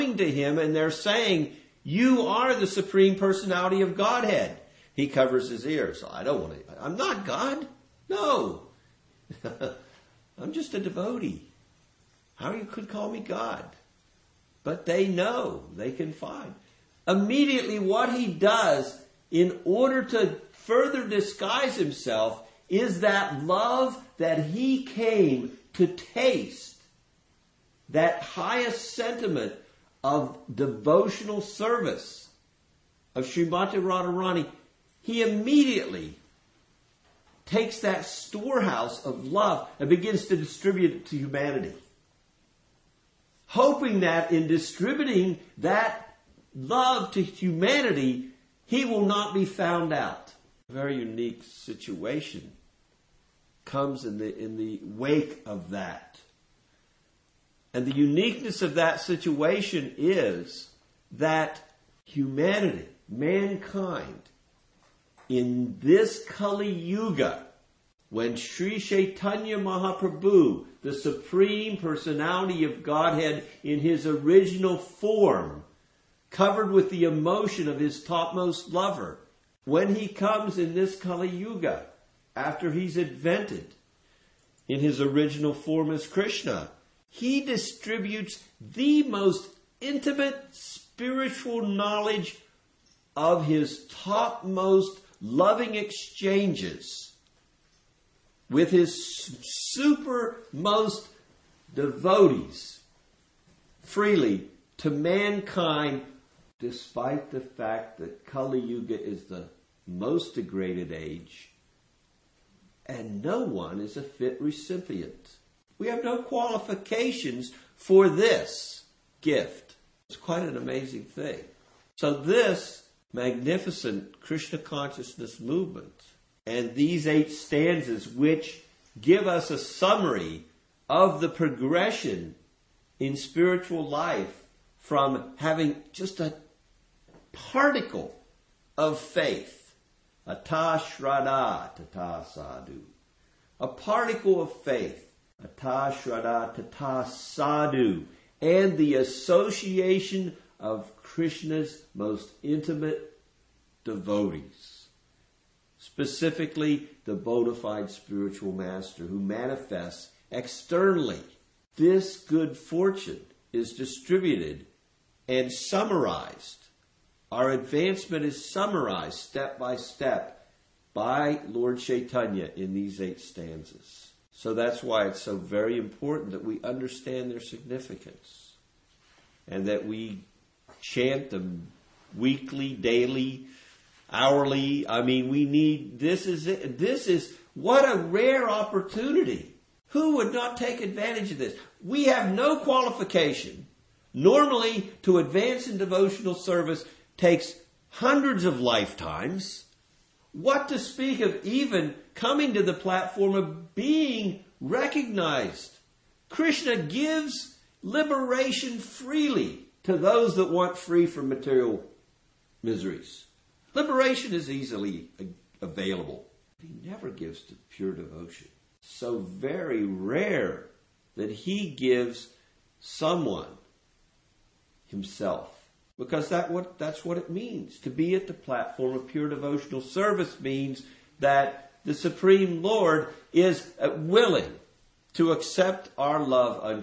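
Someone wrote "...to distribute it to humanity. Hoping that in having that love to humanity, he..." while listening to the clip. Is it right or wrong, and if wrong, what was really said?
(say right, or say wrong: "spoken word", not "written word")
wrong: "distributing", not "having".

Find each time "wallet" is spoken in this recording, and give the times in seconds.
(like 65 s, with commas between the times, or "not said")
not said.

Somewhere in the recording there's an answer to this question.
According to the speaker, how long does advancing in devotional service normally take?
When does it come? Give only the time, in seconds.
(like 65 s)
197 s.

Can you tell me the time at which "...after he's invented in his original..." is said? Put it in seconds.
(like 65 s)
82 s.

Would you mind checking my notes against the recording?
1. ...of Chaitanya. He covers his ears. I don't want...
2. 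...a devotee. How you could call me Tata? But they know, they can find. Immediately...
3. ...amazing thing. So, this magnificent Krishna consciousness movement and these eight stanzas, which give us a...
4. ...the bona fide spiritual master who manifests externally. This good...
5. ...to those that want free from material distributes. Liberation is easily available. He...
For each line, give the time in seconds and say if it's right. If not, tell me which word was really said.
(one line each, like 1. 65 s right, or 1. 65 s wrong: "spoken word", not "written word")
1. 3 s wrong: "Godhead", not "Chaitanya"
2. 10 s wrong: "God", not "Tata"
3. 120 s right
4. 157 s right
5. 209 s wrong: "miseries", not "distributes".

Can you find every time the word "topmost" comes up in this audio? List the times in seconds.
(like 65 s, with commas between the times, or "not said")
78 s, 93 s.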